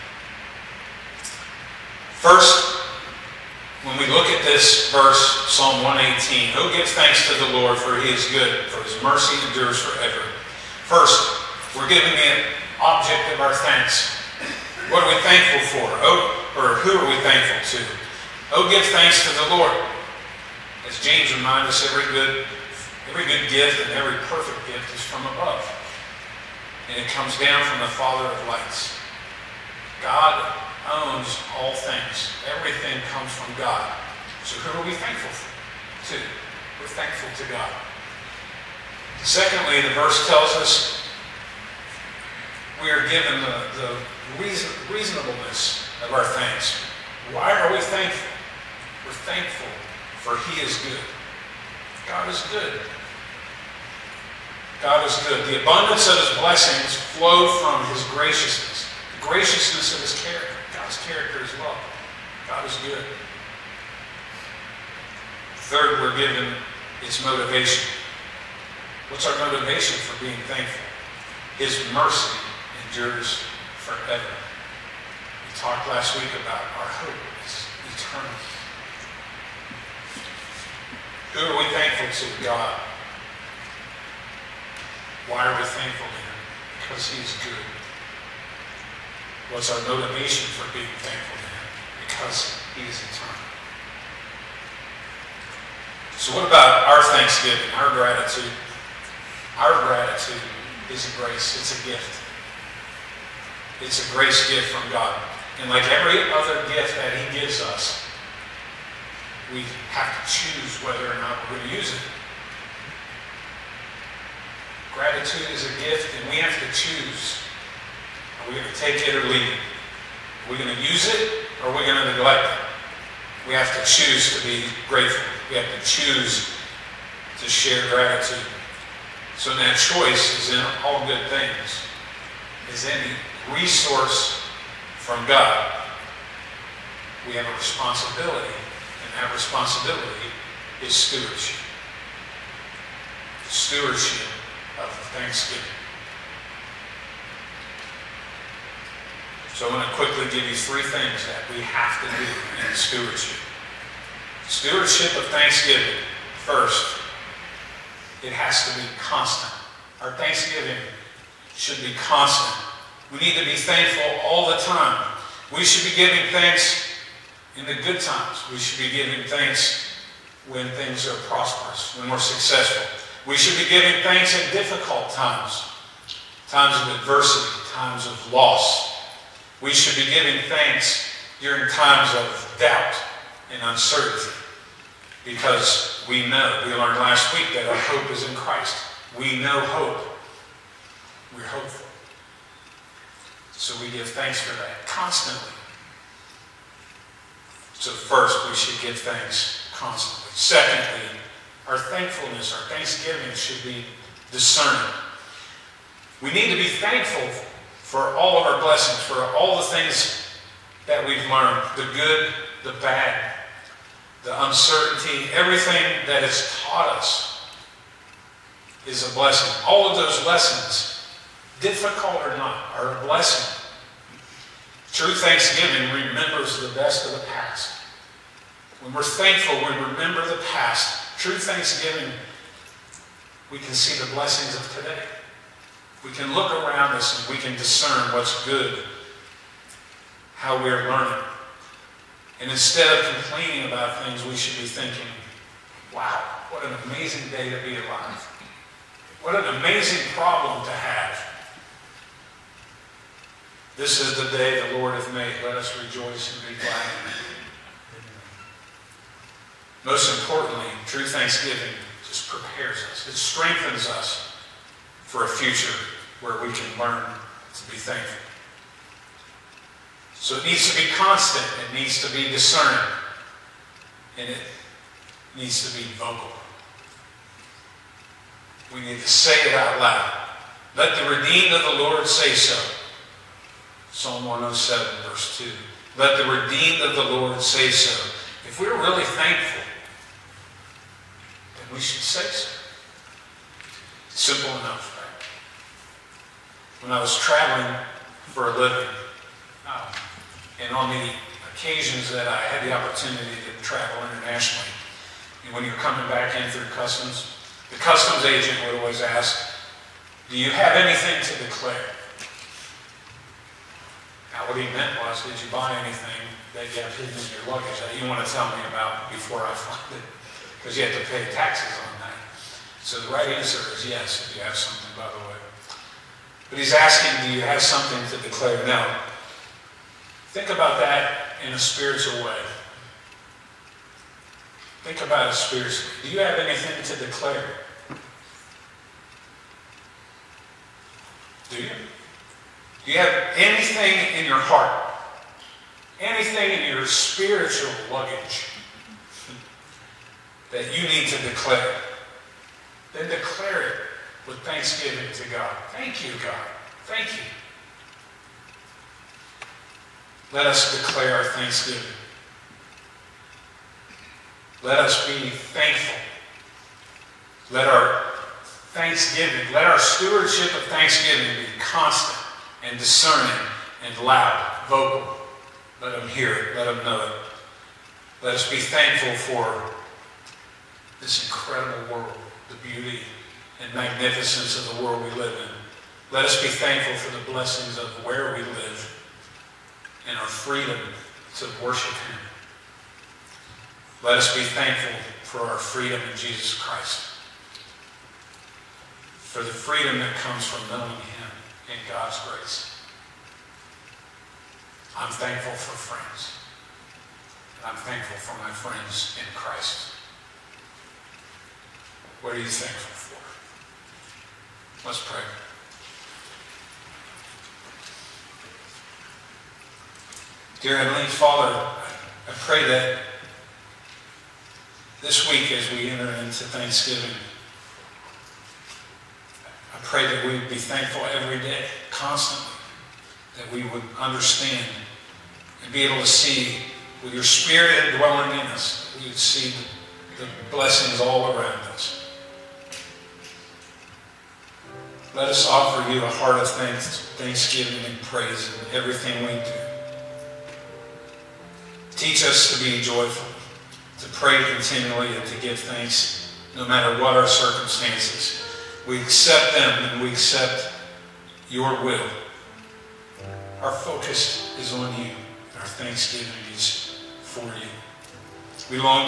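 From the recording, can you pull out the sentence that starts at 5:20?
Because you have to pay taxes on that.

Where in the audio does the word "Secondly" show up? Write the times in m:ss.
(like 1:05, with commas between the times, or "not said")
0:39, 3:20.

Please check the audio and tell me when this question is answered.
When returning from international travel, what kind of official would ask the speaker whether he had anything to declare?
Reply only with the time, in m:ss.
5:07.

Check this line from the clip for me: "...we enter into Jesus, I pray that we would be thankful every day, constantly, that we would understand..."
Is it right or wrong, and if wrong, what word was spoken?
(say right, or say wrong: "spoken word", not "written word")
wrong: "Thanksgiving", not "Jesus".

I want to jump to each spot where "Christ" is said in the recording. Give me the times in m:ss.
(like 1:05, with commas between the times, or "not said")
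3:08, 6:36, 6:49.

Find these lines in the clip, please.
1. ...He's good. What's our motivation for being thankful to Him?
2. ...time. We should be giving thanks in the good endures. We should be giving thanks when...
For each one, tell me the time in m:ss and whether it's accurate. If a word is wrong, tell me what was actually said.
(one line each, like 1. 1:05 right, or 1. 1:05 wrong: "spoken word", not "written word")
1. 1:27 right
2. 2:44 wrong: "times", not "endures".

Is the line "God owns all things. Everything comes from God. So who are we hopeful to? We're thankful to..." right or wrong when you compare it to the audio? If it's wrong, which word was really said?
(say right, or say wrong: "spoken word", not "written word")
wrong: "thankful", not "hopeful".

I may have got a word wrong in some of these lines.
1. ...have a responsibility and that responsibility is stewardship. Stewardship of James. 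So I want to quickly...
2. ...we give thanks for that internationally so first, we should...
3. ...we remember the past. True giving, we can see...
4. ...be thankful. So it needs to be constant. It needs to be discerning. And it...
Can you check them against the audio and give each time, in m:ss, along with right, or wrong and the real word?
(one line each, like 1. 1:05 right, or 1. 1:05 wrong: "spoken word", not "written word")
1. 2:17 wrong: "Thanksgiving", not "James"
2. 3:13 wrong: "constantly", not "internationally"
3. 3:49 wrong: "thanksgiving", not "giving"
4. 4:27 right.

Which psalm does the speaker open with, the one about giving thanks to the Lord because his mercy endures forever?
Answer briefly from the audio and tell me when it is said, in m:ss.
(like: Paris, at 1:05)
Psalm 118, at 0:05.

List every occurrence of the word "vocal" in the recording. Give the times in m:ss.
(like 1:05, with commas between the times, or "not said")
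4:35, 6:14.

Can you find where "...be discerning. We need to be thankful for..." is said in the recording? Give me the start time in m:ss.
3:23.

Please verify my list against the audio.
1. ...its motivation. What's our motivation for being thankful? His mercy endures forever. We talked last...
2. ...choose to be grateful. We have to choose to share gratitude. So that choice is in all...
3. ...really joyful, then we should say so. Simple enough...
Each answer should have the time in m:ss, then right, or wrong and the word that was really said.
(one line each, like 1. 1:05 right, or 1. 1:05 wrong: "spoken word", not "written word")
1. 1:07 right
2. 2:03 right
3. 4:48 wrong: "thankful", not "joyful".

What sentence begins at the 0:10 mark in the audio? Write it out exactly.
First, we're giving an object of our thanks.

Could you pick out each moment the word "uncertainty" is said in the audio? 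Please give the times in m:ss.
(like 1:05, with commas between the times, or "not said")
3:03, 3:34.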